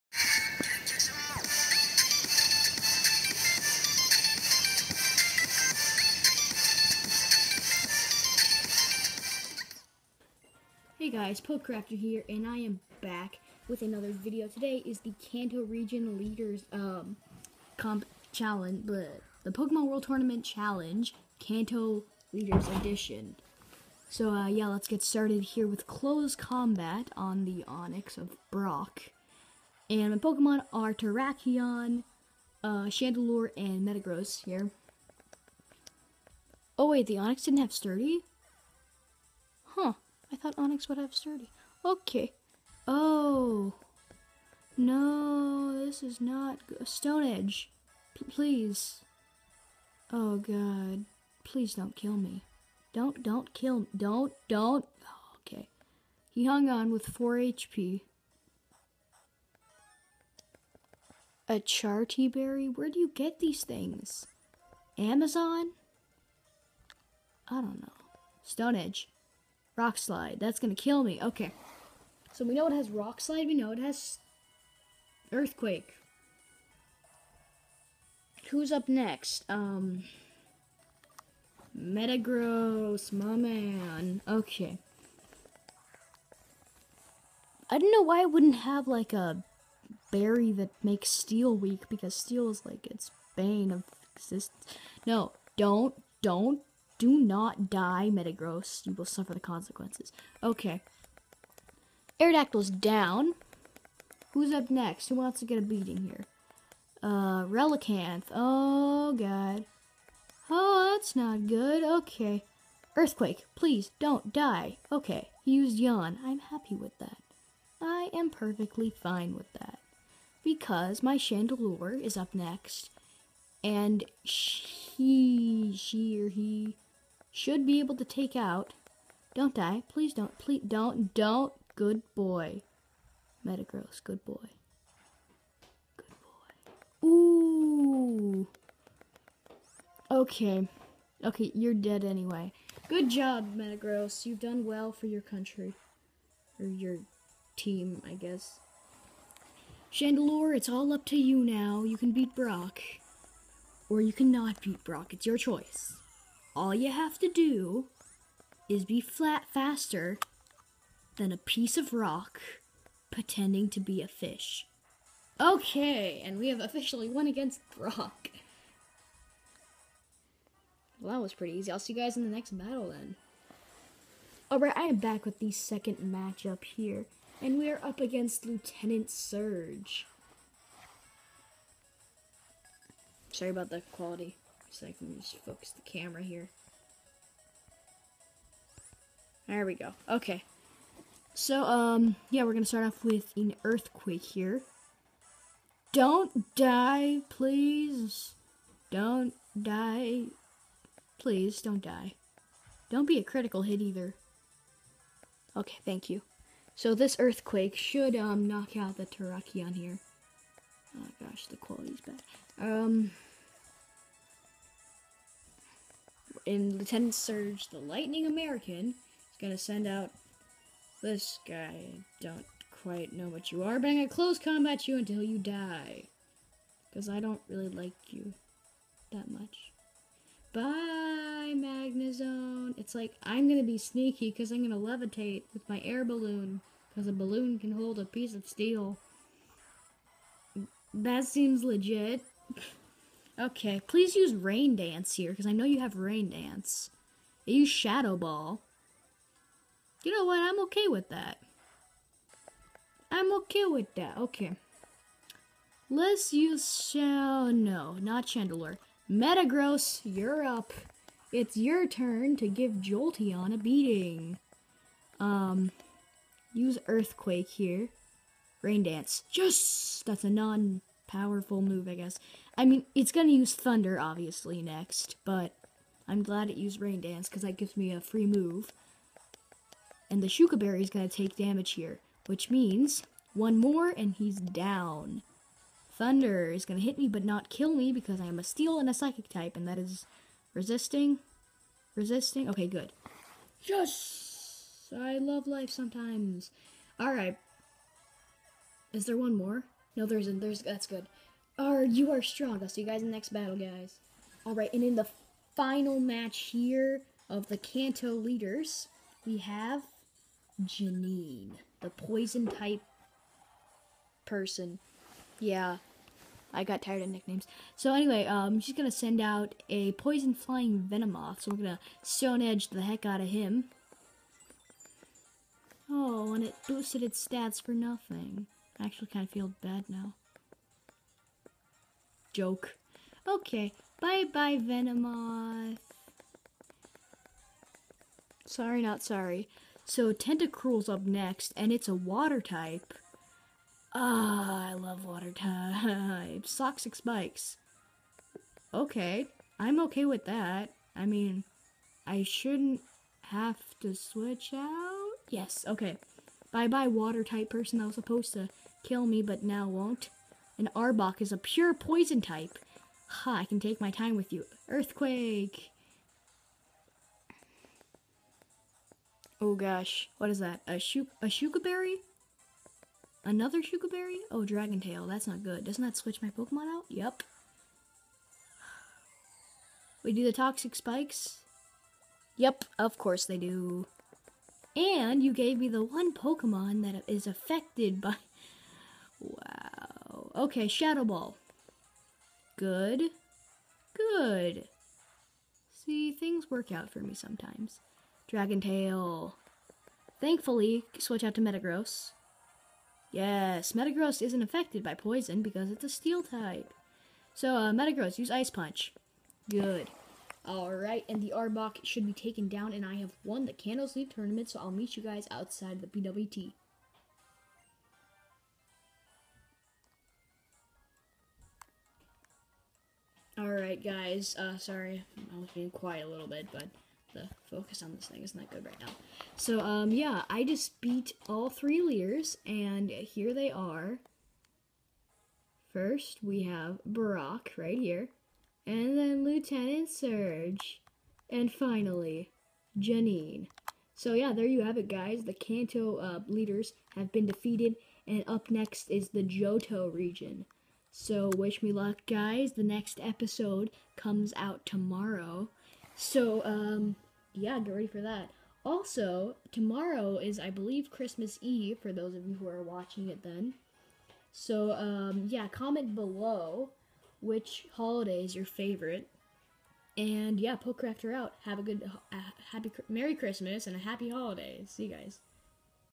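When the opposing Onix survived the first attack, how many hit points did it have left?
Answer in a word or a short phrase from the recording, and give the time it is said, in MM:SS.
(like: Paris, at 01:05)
4, at 00:57.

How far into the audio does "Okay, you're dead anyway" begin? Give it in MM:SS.
02:21.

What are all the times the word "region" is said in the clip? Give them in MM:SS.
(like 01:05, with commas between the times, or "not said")
00:15, 07:29.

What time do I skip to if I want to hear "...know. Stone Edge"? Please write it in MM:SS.
01:07.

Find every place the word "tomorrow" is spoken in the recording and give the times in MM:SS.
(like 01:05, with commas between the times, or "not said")
07:34, 07:39.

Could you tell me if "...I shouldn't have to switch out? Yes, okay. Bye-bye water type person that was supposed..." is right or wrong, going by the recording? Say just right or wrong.
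right.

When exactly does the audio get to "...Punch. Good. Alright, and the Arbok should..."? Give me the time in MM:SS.
06:48.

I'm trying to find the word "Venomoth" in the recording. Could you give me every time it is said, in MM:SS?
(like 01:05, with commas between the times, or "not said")
05:20, 05:34.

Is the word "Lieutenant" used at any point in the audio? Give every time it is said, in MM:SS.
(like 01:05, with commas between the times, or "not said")
02:58, 03:36, 07:19.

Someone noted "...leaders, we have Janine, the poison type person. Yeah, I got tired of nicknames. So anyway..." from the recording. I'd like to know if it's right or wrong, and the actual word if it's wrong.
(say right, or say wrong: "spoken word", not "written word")
right.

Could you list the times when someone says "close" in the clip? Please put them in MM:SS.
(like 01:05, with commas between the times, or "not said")
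00:25, 03:44.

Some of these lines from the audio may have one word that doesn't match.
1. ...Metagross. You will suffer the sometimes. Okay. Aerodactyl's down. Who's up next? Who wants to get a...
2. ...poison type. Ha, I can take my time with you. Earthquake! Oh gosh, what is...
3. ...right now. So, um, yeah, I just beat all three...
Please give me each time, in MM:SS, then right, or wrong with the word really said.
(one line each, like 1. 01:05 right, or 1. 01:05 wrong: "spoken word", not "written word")
1. 01:38 wrong: "consequences", not "sometimes"
2. 06:01 right
3. 07:08 right.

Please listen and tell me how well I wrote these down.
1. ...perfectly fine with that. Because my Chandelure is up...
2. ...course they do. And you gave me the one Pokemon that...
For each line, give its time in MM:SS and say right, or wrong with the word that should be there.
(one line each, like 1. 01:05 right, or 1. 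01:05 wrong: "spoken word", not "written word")
1. 01:58 right
2. 06:22 right.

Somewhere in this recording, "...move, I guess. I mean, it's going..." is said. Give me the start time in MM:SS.
04:31.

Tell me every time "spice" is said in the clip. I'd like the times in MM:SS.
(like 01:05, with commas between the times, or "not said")
not said.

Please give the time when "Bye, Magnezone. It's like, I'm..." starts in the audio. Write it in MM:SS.
03:50.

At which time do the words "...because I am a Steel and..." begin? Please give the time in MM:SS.
04:47.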